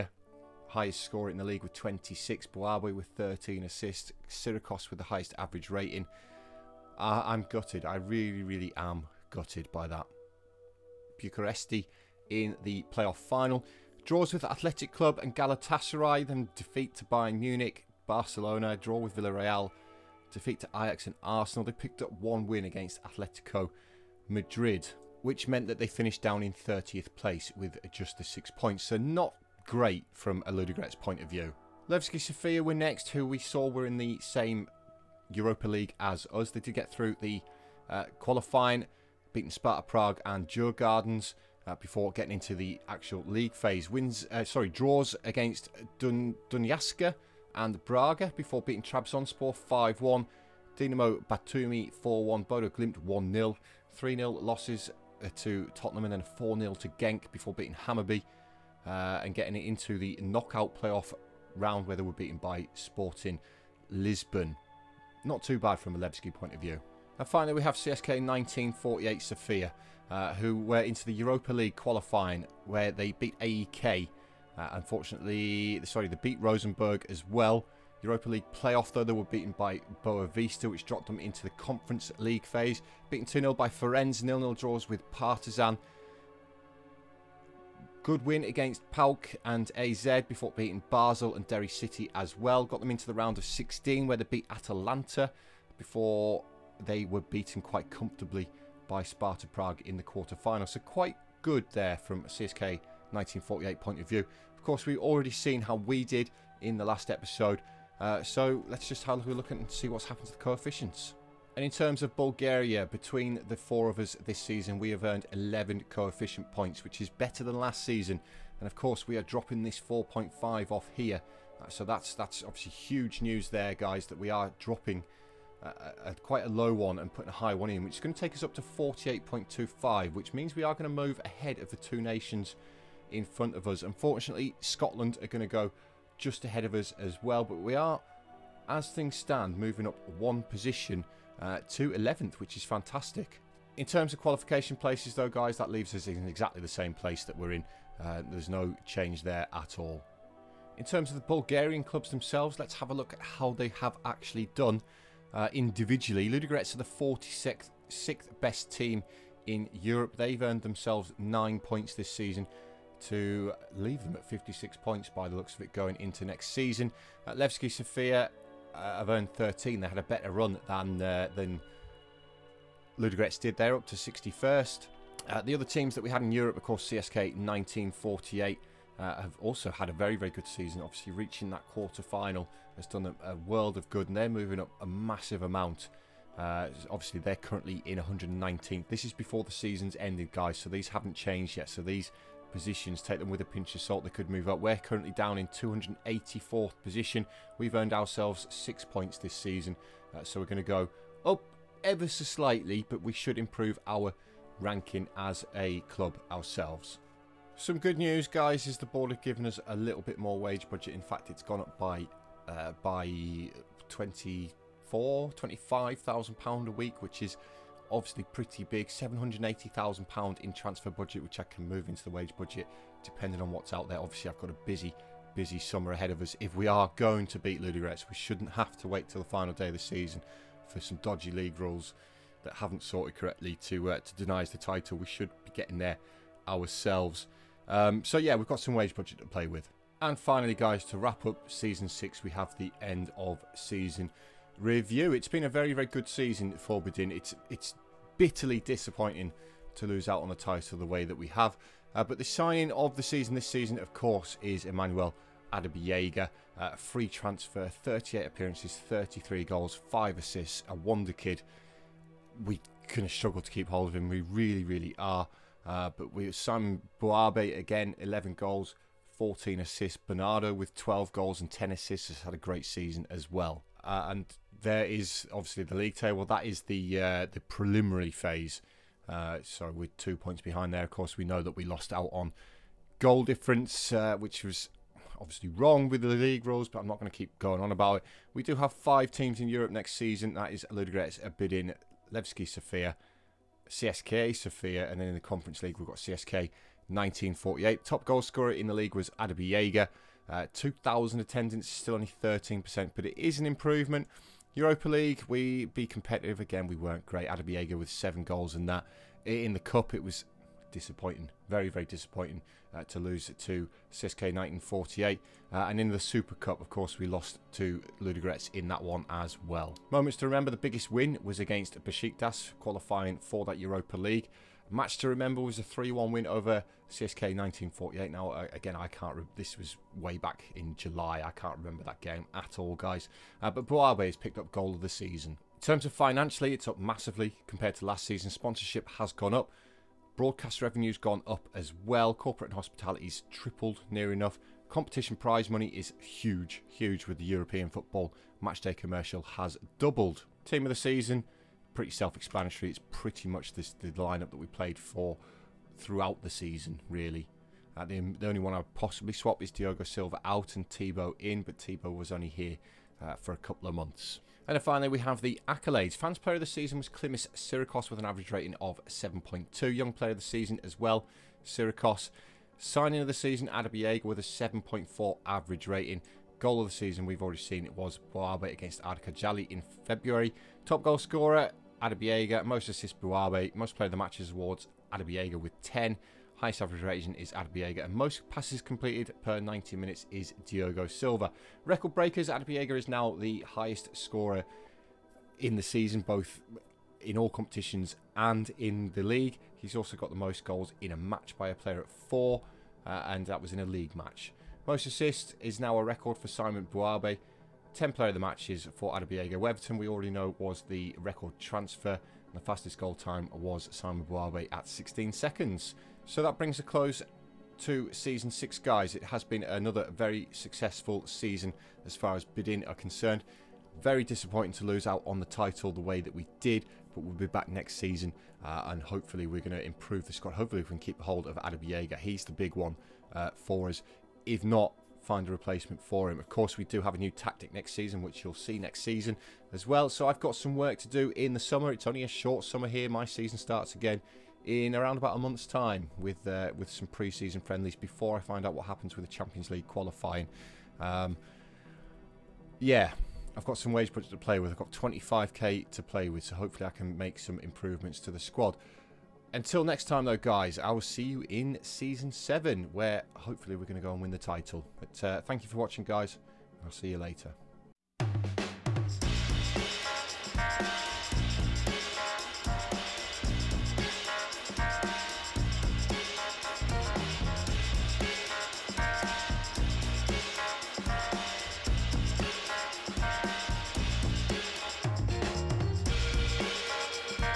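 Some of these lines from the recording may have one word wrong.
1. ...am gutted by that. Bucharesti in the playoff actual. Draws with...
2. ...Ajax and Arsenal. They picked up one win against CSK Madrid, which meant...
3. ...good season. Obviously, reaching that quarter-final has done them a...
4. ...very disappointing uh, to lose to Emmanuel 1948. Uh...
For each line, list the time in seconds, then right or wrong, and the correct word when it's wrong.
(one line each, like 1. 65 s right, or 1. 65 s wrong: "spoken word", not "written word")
1. 8 s wrong: "final", not "actual"
2. 20 s wrong: "Atletico", not "CSK"
3. 180 s right
4. 311 s wrong: "CSK", not "Emmanuel".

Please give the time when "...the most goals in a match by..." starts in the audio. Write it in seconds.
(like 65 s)
400 s.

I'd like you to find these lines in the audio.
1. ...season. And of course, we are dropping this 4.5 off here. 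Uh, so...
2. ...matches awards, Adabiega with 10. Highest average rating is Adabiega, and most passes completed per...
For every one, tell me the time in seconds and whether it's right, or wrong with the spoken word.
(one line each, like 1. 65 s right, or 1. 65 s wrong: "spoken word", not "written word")
1. 117 s right
2. 383 s right.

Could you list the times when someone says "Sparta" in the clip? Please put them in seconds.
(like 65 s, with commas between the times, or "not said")
39 s, 99 s.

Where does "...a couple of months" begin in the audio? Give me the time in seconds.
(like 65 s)
363 s.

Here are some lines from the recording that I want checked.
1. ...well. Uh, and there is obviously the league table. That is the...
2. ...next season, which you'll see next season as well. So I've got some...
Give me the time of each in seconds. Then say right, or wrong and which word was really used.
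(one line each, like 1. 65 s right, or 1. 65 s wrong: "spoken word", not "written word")
1. 273 s right
2. 437 s right.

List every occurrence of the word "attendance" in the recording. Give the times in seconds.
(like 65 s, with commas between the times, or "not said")
301 s.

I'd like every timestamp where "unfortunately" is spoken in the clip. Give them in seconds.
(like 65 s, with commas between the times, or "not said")
74 s, 133 s.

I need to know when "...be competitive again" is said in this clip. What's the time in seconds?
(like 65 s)
305 s.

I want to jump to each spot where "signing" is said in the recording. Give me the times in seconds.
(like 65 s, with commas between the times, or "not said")
252 s, 372 s.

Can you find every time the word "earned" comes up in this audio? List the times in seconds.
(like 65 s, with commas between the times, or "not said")
115 s, 160 s, 169 s, 197 s.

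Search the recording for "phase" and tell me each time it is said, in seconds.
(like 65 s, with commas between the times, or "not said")
43 s, 82 s, 278 s.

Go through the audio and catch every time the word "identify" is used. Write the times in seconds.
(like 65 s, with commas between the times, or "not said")
not said.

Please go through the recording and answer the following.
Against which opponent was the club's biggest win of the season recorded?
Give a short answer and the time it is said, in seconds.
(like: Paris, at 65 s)
Besiktas, at 321 s.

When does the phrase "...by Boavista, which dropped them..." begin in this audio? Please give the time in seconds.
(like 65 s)
79 s.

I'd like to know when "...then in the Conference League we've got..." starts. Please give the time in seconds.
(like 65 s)
295 s.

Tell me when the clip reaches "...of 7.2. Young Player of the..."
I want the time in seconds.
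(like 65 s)
368 s.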